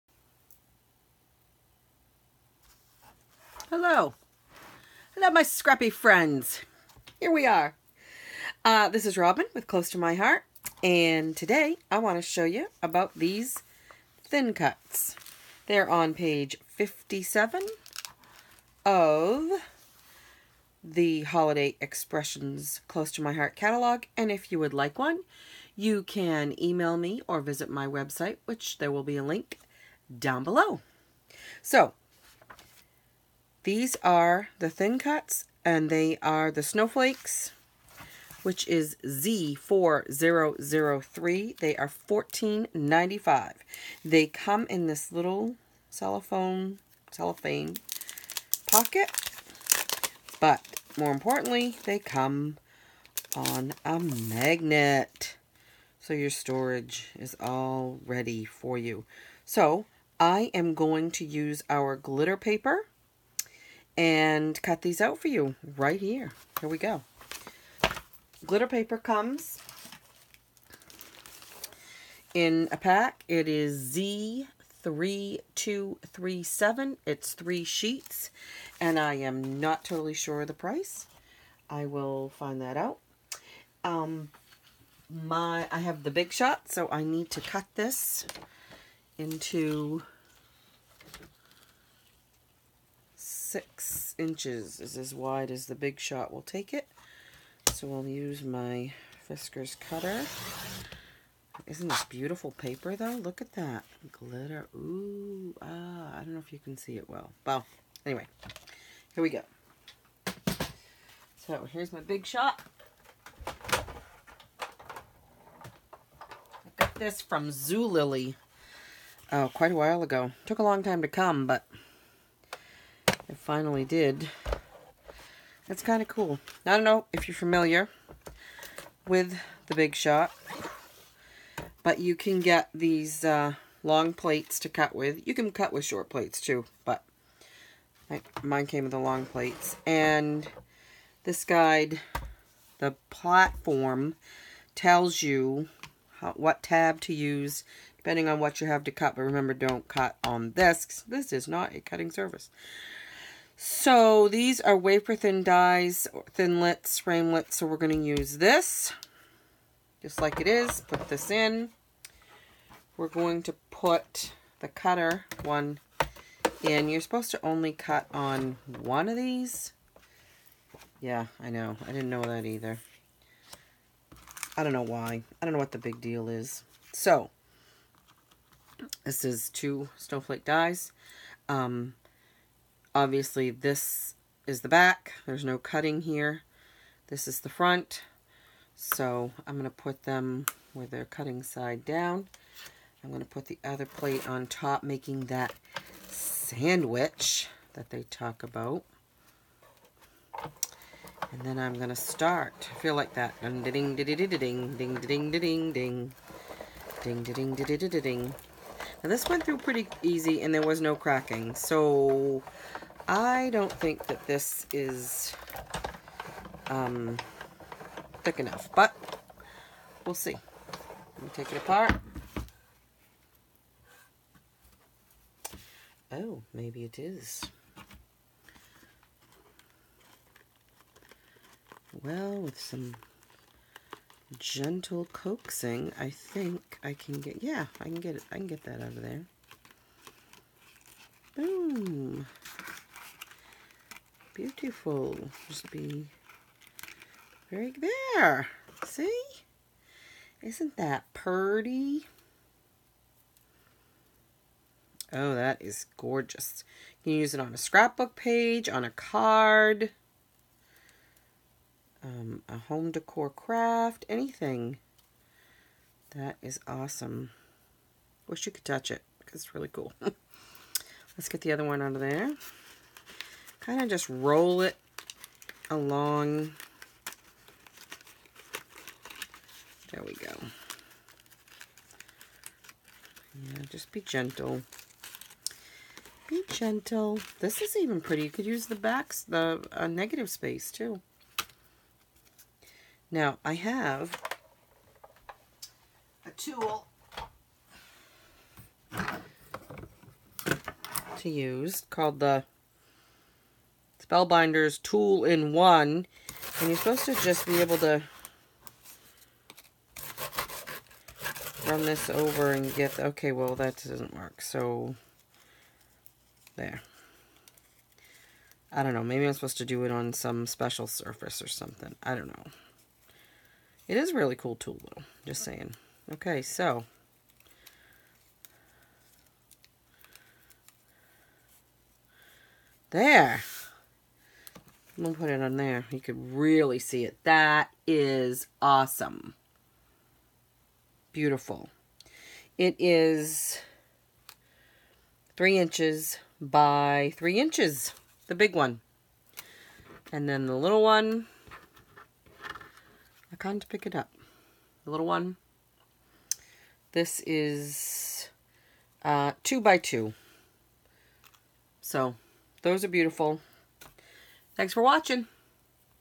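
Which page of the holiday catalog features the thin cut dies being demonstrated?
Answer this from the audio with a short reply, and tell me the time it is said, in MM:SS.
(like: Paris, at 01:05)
57, at 00:16.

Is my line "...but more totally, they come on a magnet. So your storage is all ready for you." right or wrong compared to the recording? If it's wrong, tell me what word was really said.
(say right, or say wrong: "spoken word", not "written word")
wrong: "importantly", not "totally".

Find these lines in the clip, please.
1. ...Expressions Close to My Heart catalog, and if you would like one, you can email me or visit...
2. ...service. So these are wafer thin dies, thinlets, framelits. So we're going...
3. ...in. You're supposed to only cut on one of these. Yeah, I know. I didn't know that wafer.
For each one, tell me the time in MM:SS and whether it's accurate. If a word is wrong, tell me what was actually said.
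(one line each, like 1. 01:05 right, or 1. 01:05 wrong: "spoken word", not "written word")
1. 00:21 right
2. 02:32 right
3. 02:46 wrong: "either", not "wafer".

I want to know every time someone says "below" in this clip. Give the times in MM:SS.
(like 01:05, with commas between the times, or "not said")
00:30.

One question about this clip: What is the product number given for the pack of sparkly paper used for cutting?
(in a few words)
Z3237.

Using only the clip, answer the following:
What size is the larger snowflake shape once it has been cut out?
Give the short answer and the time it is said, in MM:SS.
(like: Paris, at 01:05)
3 inches by 3 inches, at 05:45.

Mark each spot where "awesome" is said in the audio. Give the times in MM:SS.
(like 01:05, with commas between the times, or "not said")
04:26, 05:38.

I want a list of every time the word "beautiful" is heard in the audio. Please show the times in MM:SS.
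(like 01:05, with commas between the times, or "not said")
01:42, 04:04, 05:41, 06:02.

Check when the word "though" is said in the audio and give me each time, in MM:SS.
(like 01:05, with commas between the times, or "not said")
01:42, 05:24.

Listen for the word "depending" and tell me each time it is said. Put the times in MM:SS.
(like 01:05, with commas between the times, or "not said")
02:27.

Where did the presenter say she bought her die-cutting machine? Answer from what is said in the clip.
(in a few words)
Zulily.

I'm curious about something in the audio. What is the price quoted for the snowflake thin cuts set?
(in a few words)
$14.95.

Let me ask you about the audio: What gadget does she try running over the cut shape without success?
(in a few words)
Spellbinders Tool in One.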